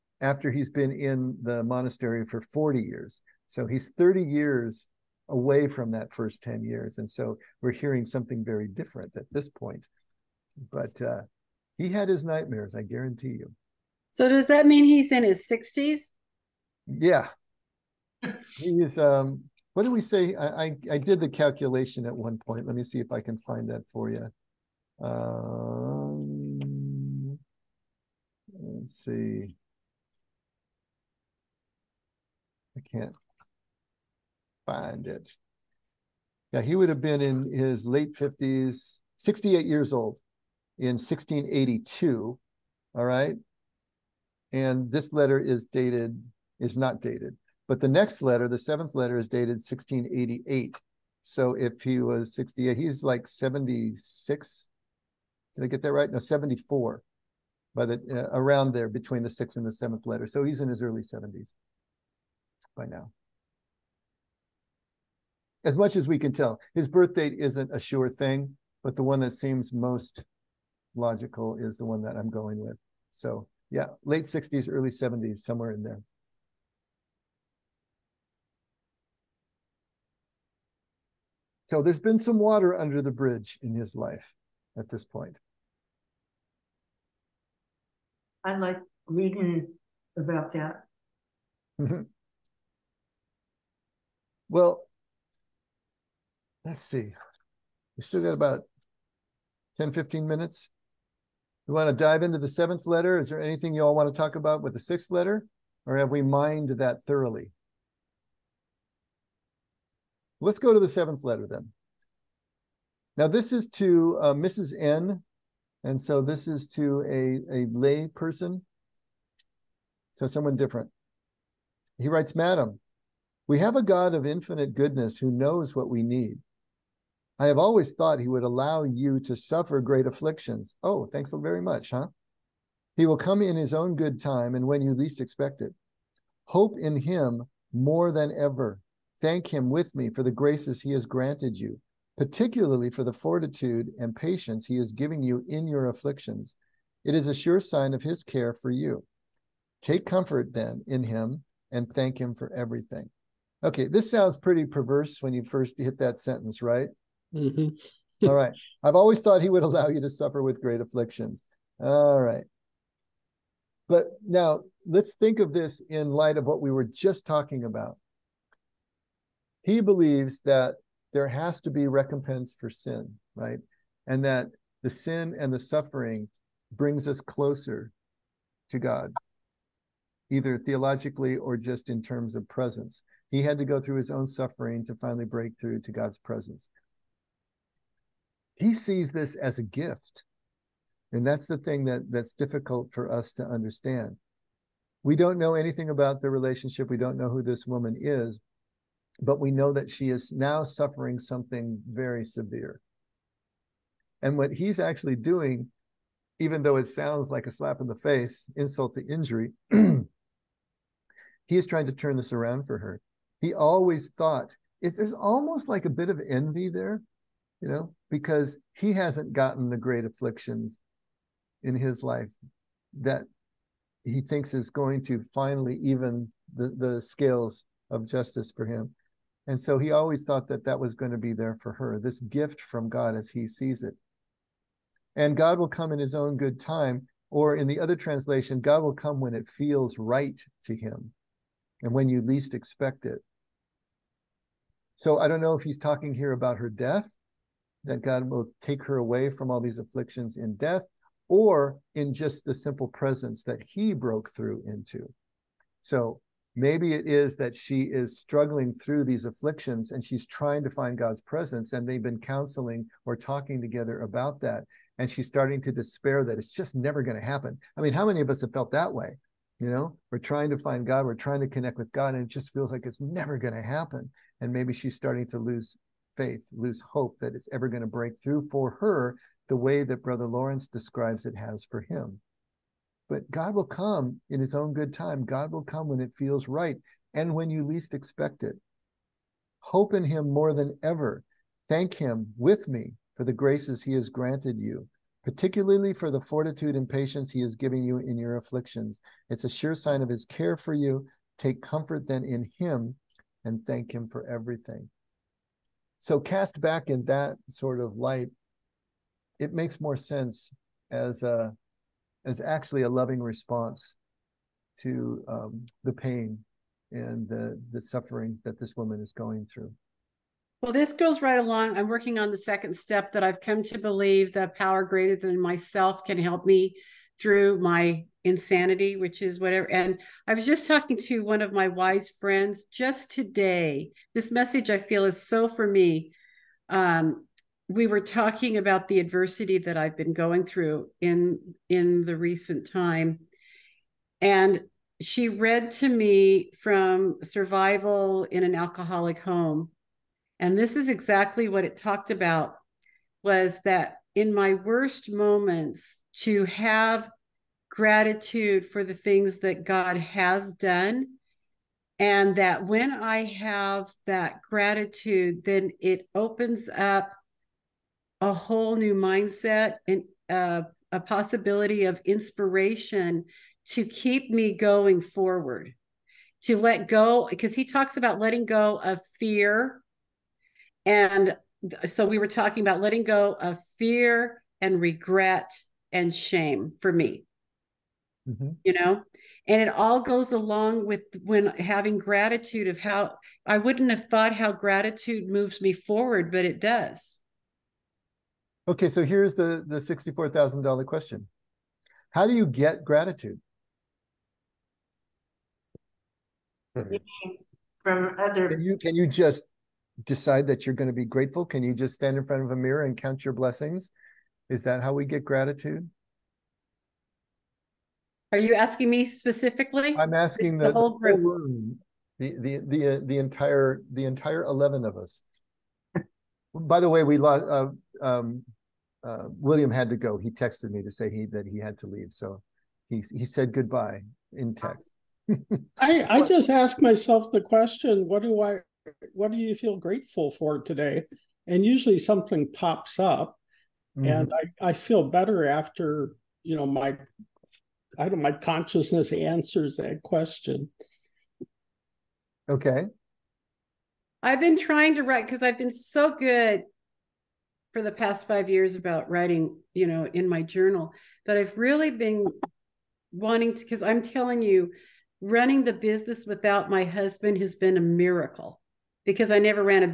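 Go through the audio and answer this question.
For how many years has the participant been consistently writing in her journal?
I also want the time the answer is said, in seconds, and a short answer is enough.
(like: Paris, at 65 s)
5 years, at 458 s.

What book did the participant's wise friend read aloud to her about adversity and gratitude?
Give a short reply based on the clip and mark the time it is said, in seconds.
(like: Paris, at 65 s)
Survival in an Alcoholic Home, at 347 s.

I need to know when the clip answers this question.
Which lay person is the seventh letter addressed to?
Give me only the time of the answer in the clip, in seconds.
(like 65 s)
114 s.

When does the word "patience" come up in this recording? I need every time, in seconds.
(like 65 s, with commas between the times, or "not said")
144 s, 296 s.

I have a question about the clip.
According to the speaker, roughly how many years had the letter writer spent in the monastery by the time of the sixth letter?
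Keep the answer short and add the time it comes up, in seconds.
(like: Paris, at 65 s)
40 years, at 2 s.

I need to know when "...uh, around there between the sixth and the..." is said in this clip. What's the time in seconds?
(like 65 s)
58 s.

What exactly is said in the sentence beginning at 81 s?
So there's been some water under the bridge in his life at this point.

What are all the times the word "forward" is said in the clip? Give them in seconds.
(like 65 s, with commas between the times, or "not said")
374 s, 395 s.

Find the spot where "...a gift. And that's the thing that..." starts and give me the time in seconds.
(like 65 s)
189 s.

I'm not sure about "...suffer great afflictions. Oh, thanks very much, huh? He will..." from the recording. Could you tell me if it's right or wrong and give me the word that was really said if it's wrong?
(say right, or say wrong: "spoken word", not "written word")
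right.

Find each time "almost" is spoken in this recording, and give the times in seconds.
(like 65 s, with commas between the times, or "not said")
215 s.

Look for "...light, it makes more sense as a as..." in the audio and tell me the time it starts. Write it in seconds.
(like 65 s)
307 s.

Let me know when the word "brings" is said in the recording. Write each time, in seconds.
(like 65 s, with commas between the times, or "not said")
176 s.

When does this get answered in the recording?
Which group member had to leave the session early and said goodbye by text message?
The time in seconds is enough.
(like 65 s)
429 s.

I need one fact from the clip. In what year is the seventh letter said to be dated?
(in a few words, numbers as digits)
1688.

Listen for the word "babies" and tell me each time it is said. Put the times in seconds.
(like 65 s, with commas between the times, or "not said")
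not said.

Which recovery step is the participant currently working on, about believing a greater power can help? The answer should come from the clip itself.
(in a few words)
Second step.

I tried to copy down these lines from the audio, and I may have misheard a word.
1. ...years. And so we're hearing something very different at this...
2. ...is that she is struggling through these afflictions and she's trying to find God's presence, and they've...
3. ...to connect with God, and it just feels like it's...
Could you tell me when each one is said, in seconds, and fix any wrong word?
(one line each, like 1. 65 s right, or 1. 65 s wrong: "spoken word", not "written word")
1. 6 s right
2. 257 s right
3. 271 s right.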